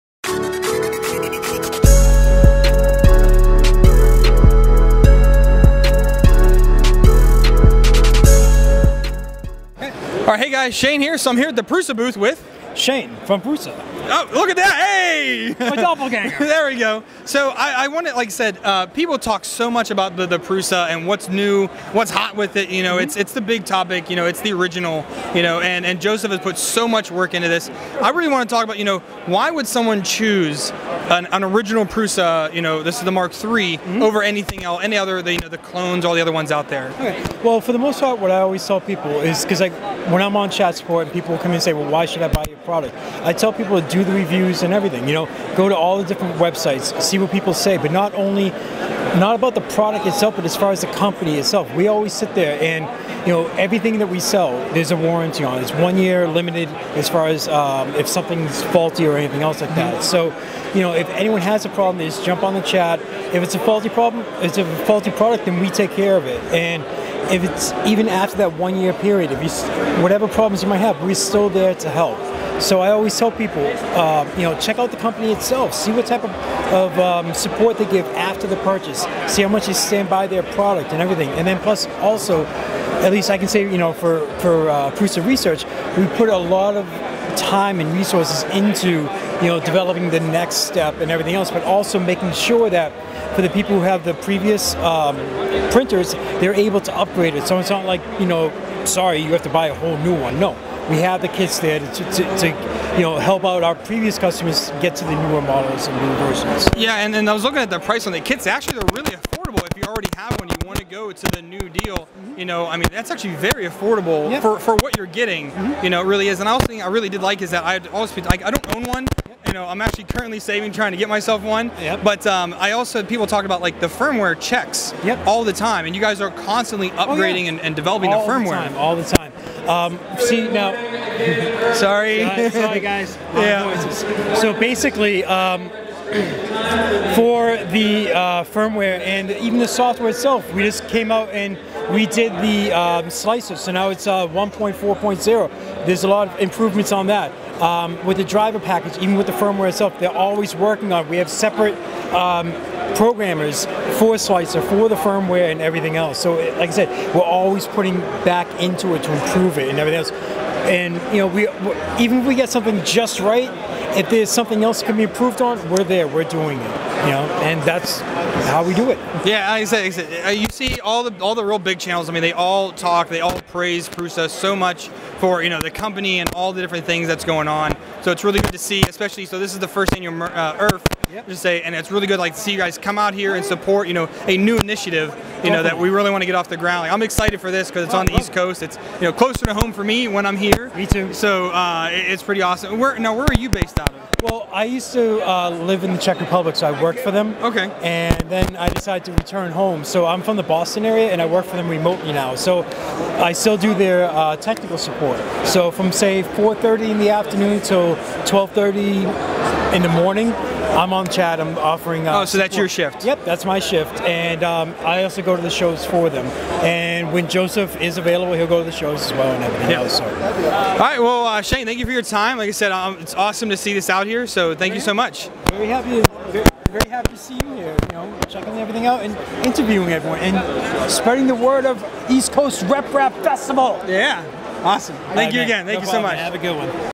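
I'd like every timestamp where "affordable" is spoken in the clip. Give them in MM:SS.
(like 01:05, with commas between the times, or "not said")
01:49, 01:53.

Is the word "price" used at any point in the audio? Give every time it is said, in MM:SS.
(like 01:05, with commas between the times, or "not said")
01:47.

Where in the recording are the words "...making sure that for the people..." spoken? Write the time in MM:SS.
01:31.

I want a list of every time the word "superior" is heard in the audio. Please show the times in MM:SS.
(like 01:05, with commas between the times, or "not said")
not said.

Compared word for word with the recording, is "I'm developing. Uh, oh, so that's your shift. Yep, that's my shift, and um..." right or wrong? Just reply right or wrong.
wrong.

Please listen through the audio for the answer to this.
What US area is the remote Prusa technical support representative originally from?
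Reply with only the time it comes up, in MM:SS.
03:20.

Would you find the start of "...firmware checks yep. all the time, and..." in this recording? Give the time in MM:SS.
02:03.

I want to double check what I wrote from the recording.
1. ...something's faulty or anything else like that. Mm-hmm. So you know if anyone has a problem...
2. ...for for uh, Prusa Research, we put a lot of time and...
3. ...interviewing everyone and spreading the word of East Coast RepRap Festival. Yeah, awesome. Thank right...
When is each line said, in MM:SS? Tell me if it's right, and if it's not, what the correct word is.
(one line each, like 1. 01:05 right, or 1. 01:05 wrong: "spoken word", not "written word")
1. 00:58 right
2. 01:23 right
3. 03:49 right.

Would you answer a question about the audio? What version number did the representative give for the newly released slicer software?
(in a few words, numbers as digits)
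1.4.0.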